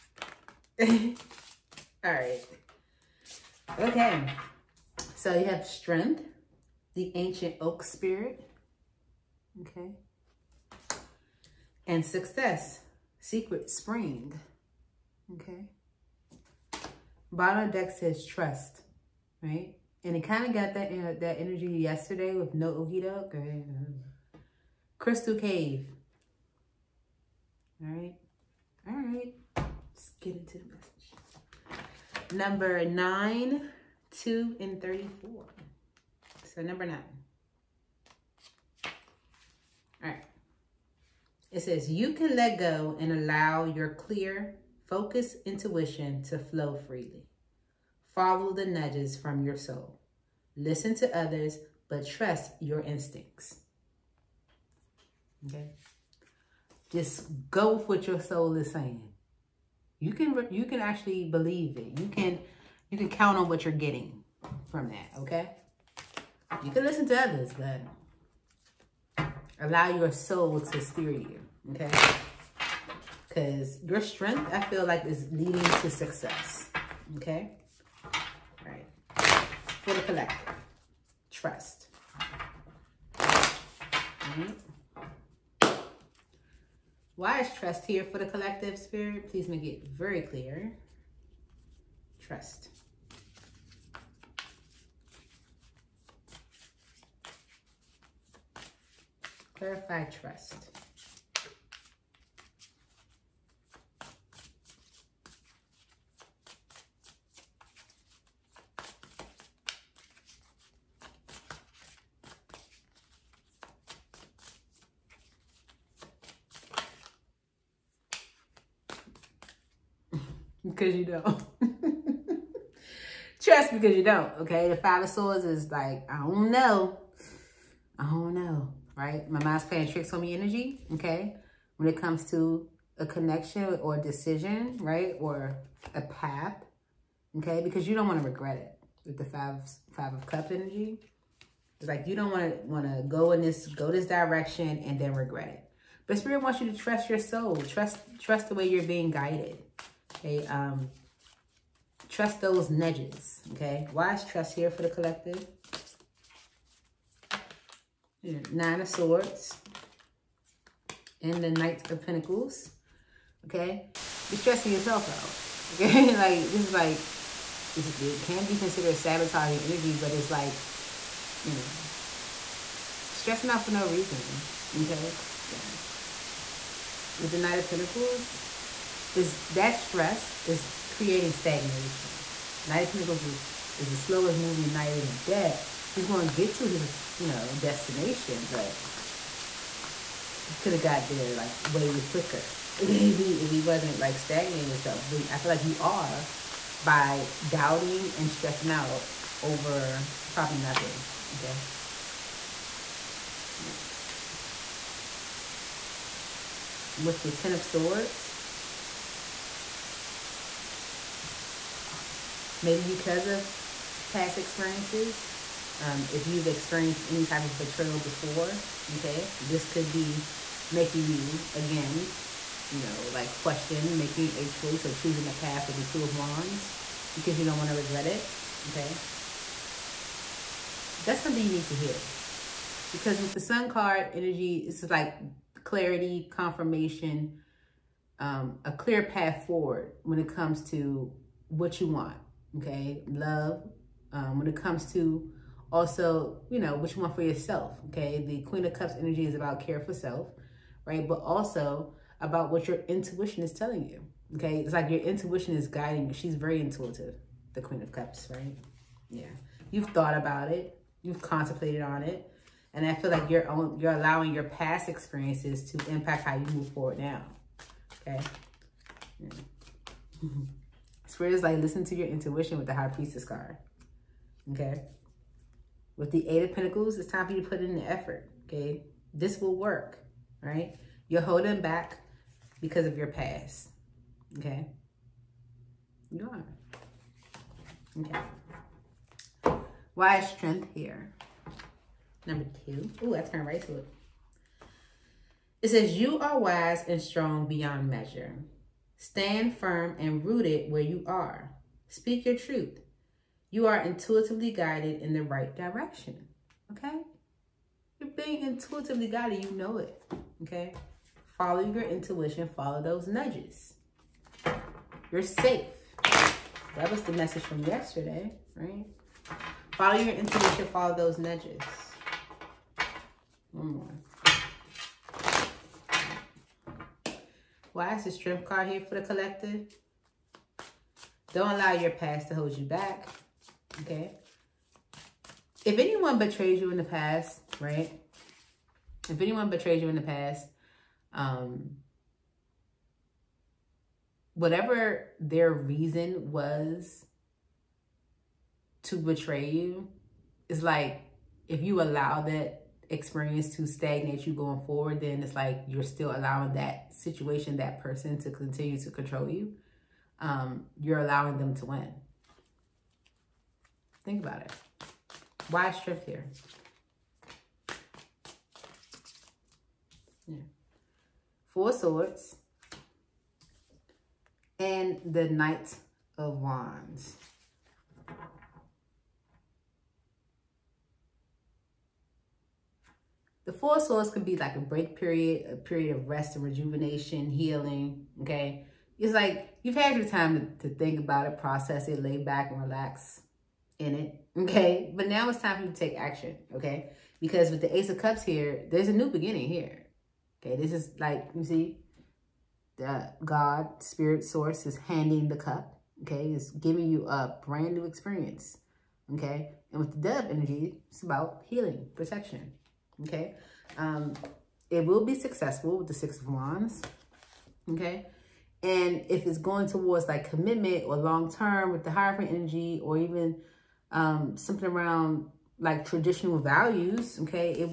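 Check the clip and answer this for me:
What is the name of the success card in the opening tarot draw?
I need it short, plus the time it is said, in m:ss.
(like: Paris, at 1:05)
Secret spring, at 0:13.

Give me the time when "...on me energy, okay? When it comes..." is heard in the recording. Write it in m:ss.
2:10.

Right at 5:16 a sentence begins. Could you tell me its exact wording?
That was the message from yesterday, right?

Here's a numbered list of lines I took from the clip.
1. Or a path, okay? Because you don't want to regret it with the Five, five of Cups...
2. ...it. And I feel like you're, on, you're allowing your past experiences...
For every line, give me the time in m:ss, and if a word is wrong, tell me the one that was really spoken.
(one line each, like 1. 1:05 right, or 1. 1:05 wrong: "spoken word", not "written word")
1. 2:15 right
2. 4:22 right.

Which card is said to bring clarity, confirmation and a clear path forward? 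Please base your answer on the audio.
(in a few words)
The Sun.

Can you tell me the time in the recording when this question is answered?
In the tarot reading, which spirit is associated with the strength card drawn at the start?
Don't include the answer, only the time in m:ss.
0:06.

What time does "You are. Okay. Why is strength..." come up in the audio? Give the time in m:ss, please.
4:46.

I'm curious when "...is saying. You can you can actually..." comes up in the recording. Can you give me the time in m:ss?
0:58.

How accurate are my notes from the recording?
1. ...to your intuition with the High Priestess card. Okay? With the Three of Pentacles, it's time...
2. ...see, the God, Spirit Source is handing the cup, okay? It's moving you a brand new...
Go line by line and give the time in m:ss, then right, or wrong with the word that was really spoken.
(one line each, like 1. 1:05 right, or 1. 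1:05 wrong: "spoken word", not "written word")
1. 4:31 wrong: "Eight", not "Three"
2. 6:41 wrong: "giving", not "moving".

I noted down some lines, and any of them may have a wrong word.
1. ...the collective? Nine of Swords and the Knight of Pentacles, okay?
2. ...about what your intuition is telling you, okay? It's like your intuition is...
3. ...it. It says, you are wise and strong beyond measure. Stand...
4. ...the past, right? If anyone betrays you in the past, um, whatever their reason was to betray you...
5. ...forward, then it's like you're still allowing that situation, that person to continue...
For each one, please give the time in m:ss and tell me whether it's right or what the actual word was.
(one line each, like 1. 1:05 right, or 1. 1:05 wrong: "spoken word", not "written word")
1. 2:34 right
2. 4:12 right
3. 4:53 right
4. 5:36 right
5. 5:54 right.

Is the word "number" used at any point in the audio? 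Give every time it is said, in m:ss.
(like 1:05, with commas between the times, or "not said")
0:32, 0:36, 4:52.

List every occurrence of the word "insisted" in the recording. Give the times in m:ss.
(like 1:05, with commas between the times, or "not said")
not said.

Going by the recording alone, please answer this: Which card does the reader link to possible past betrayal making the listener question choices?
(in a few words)
Ten of Swords.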